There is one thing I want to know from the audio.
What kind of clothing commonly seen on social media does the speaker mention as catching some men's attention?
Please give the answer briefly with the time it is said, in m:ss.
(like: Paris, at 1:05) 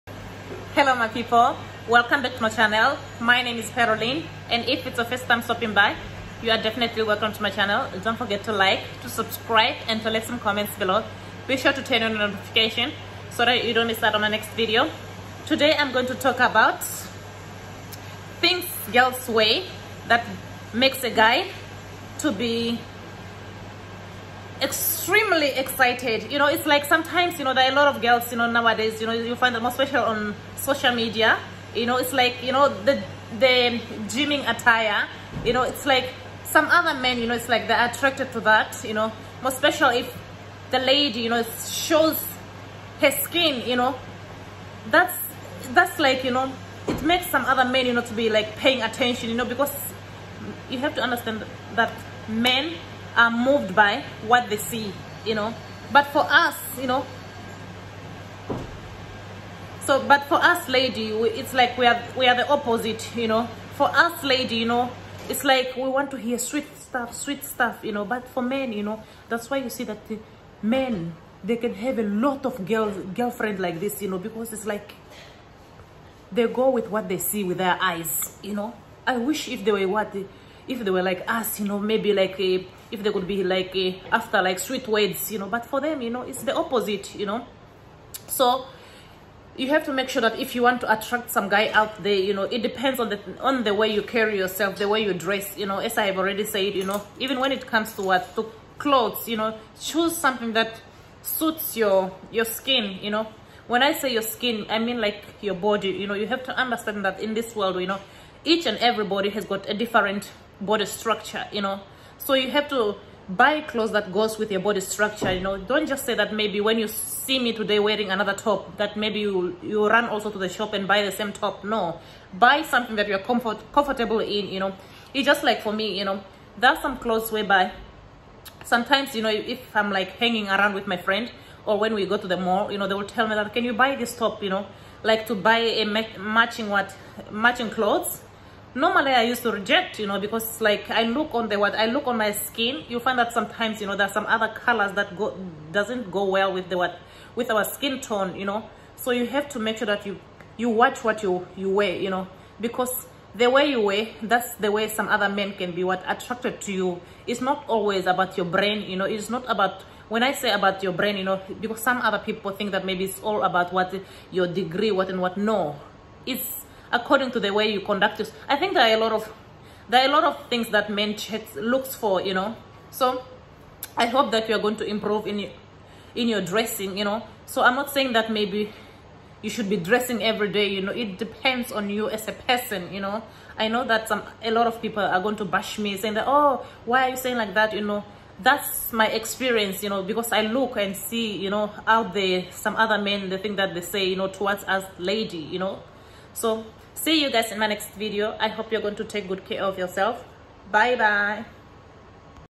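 Gymming attire, at 0:34.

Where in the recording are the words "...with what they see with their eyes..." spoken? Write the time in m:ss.
1:16.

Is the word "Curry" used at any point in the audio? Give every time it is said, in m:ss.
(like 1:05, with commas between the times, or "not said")
not said.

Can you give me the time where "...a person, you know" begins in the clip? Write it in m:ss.
3:02.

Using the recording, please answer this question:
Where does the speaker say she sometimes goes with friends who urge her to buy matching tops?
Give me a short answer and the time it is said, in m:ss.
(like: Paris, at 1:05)
The mall, at 2:12.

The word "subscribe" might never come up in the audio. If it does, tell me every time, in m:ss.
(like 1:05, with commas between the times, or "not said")
0:09.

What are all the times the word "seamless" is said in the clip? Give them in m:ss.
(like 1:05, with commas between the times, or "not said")
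not said.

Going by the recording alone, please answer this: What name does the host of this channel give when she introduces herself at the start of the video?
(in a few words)
Caroline.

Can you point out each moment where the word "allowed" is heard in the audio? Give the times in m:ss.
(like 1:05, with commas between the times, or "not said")
not said.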